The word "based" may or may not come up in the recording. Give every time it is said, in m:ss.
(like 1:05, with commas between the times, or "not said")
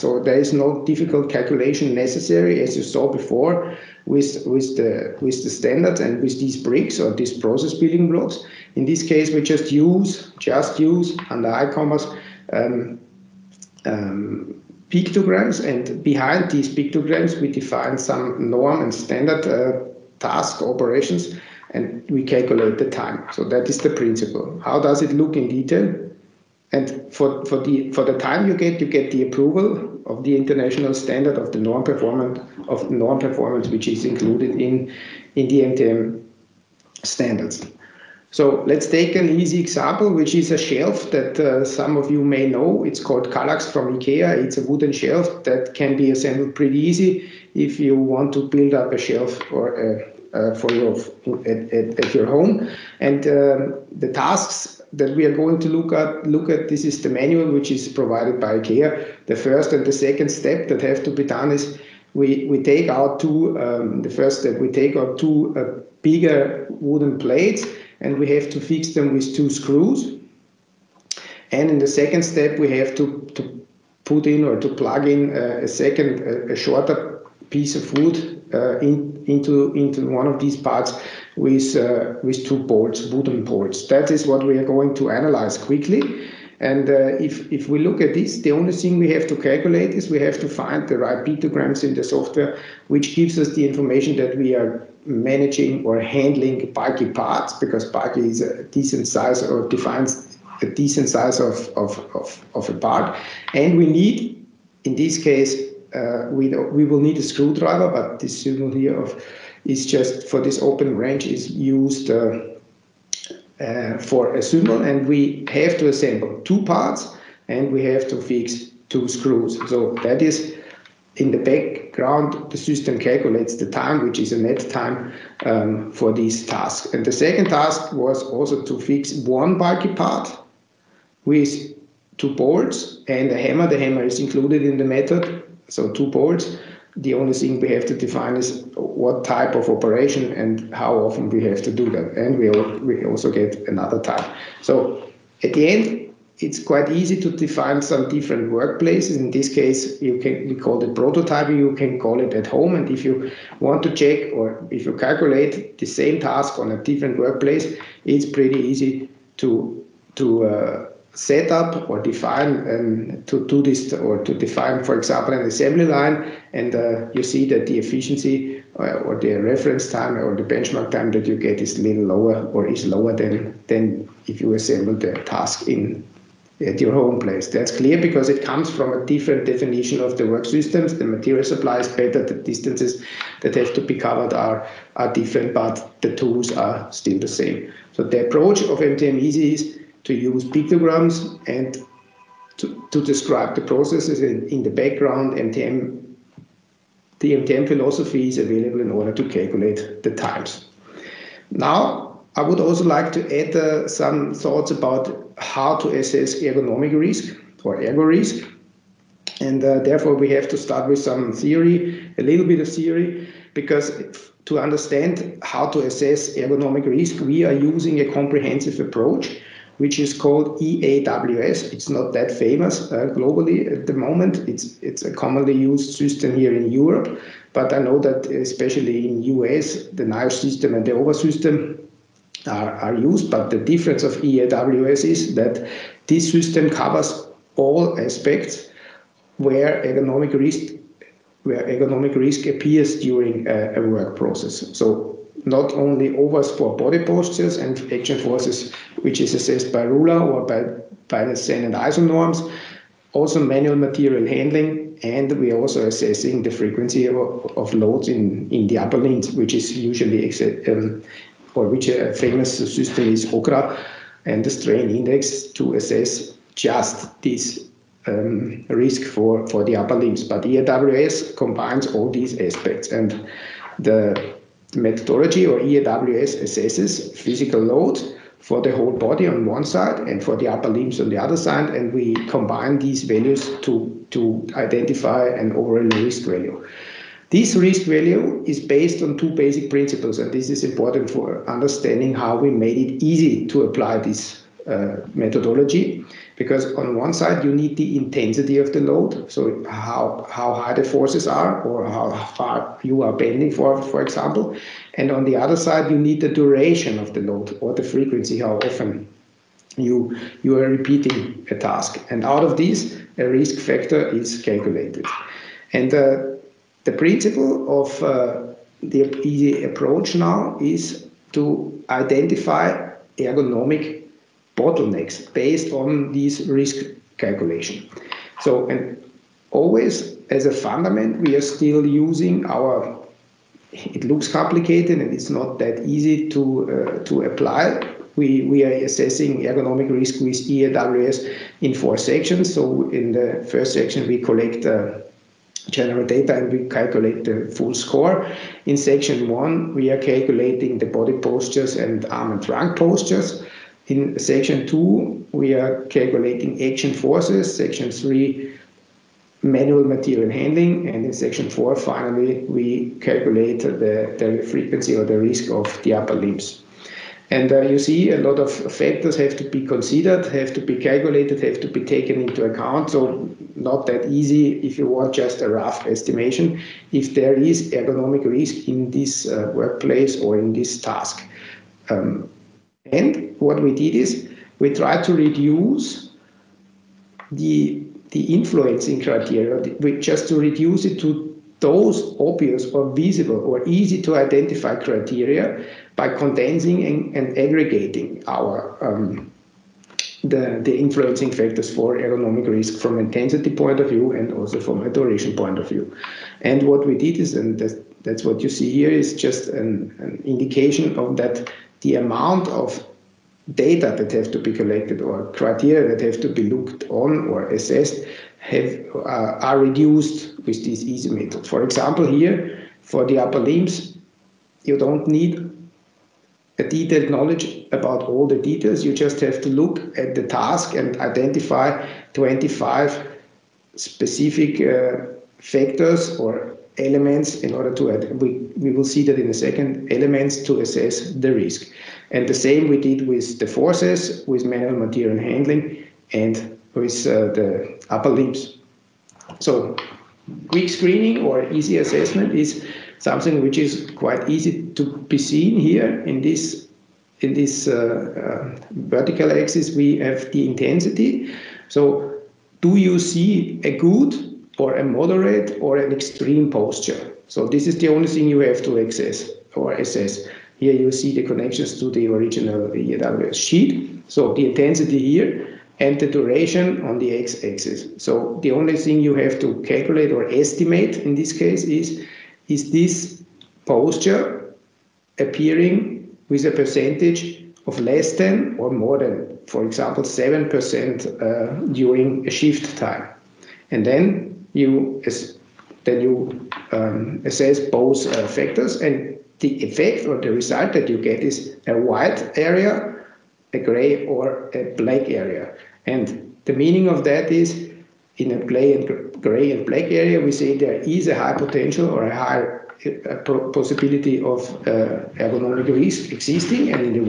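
4:48, 5:25.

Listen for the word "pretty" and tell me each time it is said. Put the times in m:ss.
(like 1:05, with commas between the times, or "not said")
0:46, 2:38.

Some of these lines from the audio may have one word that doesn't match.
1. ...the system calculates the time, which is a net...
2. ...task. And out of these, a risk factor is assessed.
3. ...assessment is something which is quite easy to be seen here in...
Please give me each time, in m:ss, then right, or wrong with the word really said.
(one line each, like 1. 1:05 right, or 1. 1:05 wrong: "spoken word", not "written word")
1. 2:02 right
2. 5:11 wrong: "calculated", not "assessed"
3. 7:31 right.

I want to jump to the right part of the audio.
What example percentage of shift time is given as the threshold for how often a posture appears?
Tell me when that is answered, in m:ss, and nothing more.
8:10.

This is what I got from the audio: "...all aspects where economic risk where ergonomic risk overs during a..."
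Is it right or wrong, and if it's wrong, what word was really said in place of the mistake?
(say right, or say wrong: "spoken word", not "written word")
wrong: "appears", not "overs".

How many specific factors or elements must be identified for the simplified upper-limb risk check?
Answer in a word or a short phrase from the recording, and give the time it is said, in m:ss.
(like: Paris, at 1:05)
25, at 7:12.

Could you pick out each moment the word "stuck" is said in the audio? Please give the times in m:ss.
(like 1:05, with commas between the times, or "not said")
not said.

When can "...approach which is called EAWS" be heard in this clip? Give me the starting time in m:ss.
3:38.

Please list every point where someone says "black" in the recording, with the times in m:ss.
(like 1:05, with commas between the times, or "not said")
8:24, 8:29.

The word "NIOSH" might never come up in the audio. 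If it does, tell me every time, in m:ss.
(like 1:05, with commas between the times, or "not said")
3:50.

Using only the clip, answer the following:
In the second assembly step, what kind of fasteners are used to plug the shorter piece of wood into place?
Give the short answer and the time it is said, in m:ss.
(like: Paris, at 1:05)
wooden bolts, at 1:23.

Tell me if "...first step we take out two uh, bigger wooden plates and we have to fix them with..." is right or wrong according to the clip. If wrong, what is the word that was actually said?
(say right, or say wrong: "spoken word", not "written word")
right.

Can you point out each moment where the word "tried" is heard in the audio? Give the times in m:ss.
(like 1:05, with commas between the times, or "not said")
6:24.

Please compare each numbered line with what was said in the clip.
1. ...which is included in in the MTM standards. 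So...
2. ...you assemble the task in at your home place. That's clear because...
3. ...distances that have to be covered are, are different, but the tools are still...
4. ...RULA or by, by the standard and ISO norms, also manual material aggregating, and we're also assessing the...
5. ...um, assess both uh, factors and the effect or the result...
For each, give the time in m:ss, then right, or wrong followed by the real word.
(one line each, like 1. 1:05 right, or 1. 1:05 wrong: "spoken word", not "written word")
1. 0:33 right
2. 2:54 right
3. 3:02 right
4. 4:09 wrong: "handling", not "aggregating"
5. 8:16 right.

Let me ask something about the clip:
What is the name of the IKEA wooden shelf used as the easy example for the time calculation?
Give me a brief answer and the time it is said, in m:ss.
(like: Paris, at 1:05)
Kallax, at 0:43.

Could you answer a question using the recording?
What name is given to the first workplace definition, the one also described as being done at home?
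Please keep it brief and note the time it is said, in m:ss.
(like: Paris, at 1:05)
prototyping, at 2:30.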